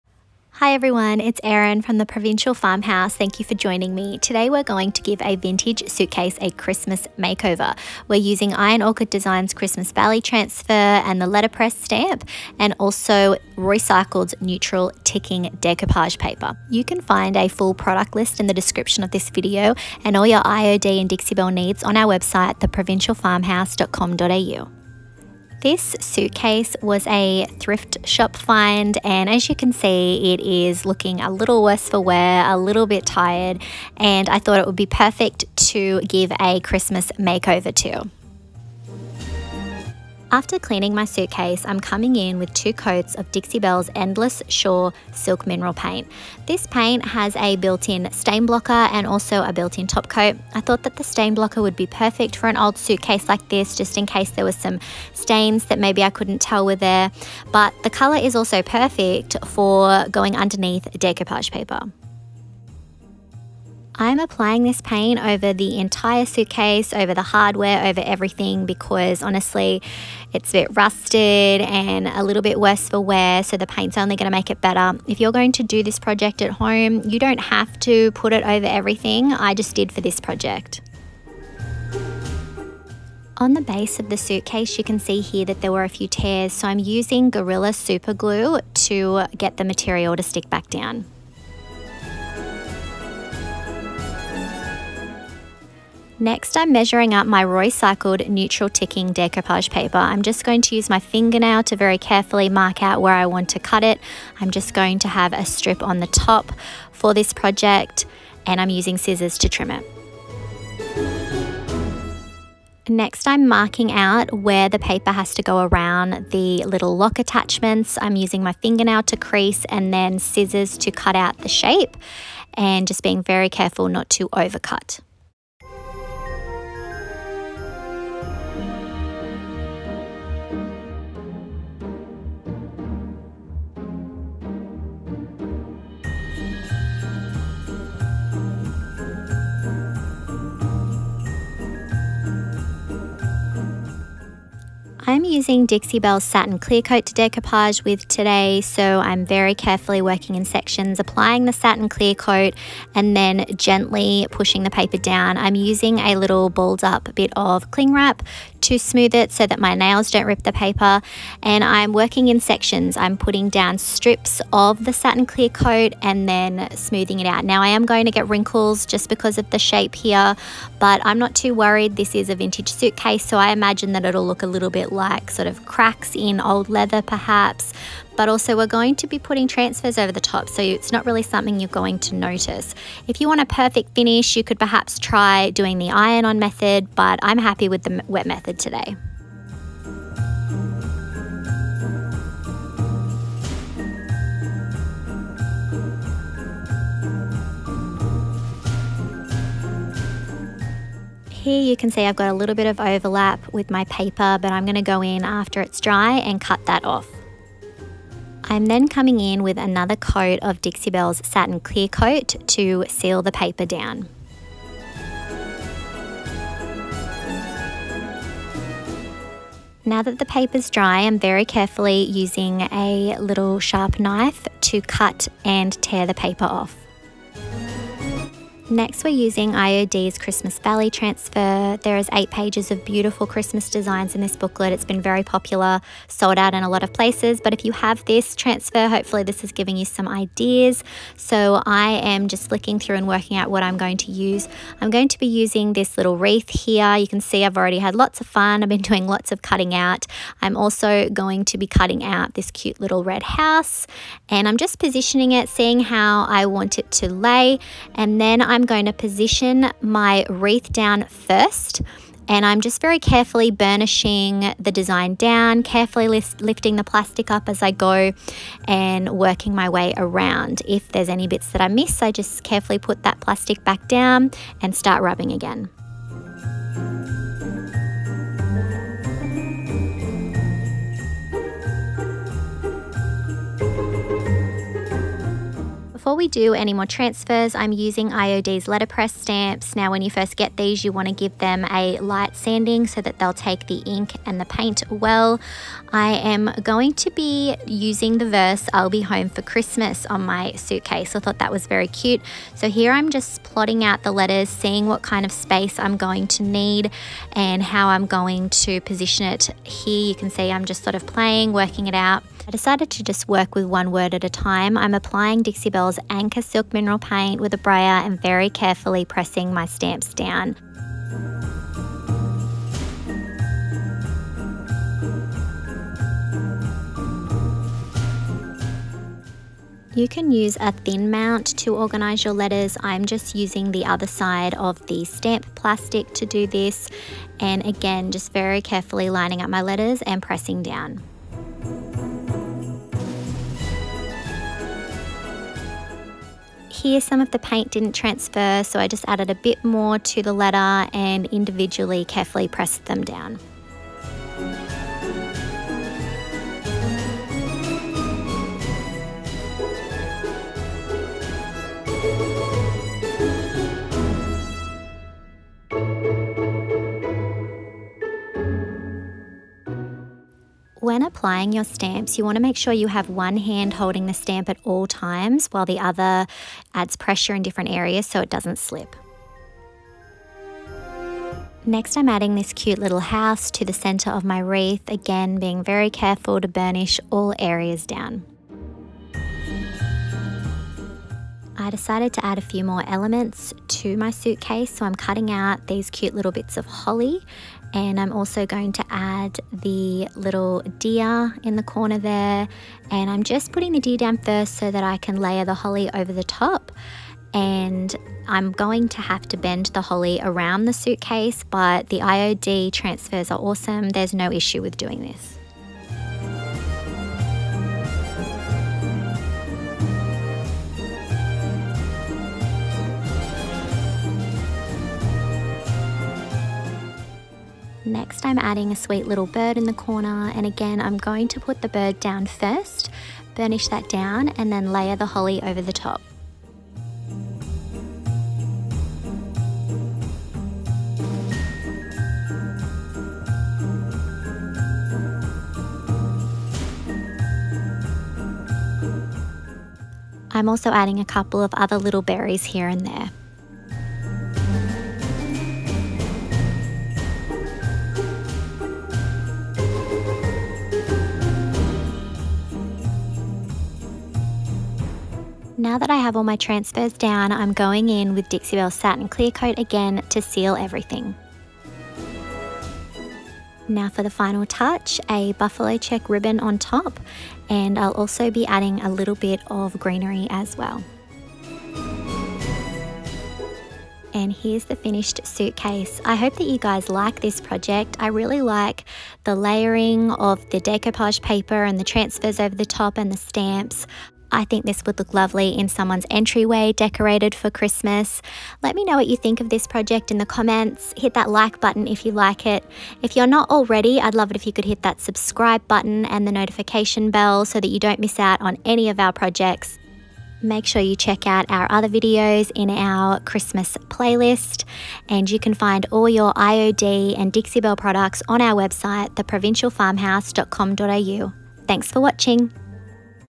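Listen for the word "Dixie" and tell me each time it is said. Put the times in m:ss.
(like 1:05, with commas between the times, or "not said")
0:21, 0:43, 2:25, 3:30, 5:15, 7:48, 8:37.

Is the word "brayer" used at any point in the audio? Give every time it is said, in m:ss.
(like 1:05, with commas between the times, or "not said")
5:17.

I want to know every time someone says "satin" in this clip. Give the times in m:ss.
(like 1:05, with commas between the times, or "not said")
2:26, 2:31, 2:44, 3:31, 7:48.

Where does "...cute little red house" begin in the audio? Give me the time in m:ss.
4:12.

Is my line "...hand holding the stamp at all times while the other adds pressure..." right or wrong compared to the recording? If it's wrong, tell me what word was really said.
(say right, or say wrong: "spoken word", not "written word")
right.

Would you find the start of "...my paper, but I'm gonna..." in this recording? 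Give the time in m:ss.
3:23.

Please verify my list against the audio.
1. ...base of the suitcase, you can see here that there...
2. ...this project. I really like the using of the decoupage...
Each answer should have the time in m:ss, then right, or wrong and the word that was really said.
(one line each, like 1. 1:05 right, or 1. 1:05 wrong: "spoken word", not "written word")
1. 1:23 right
2. 8:07 wrong: "layering", not "using".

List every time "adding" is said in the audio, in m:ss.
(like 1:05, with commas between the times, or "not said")
6:22, 7:08, 7:30, 7:58.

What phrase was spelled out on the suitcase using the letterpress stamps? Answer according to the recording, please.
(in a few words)
I'll be home for Christmas.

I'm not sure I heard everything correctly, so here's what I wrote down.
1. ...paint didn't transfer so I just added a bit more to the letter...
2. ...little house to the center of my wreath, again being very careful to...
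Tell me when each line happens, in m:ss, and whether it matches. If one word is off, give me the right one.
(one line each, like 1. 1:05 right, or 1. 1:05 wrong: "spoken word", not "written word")
1. 5:47 right
2. 6:22 right.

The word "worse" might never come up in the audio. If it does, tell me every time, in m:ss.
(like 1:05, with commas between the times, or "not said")
0:31, 1:12.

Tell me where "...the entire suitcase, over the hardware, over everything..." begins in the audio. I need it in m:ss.
1:05.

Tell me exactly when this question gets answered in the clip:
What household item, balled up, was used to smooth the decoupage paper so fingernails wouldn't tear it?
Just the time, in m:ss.
2:37.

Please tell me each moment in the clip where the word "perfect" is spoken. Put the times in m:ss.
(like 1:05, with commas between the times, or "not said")
0:34, 0:51, 0:58, 3:03.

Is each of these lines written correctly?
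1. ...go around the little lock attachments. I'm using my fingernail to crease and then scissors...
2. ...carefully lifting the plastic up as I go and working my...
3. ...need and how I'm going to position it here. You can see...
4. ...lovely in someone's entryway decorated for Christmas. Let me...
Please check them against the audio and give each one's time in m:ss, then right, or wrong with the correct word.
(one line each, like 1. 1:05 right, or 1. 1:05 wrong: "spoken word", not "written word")
1. 1:55 right
2. 4:25 right
3. 5:06 right
4. 8:15 right.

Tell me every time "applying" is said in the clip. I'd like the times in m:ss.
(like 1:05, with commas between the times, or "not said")
1:04, 2:31, 5:14, 6:11.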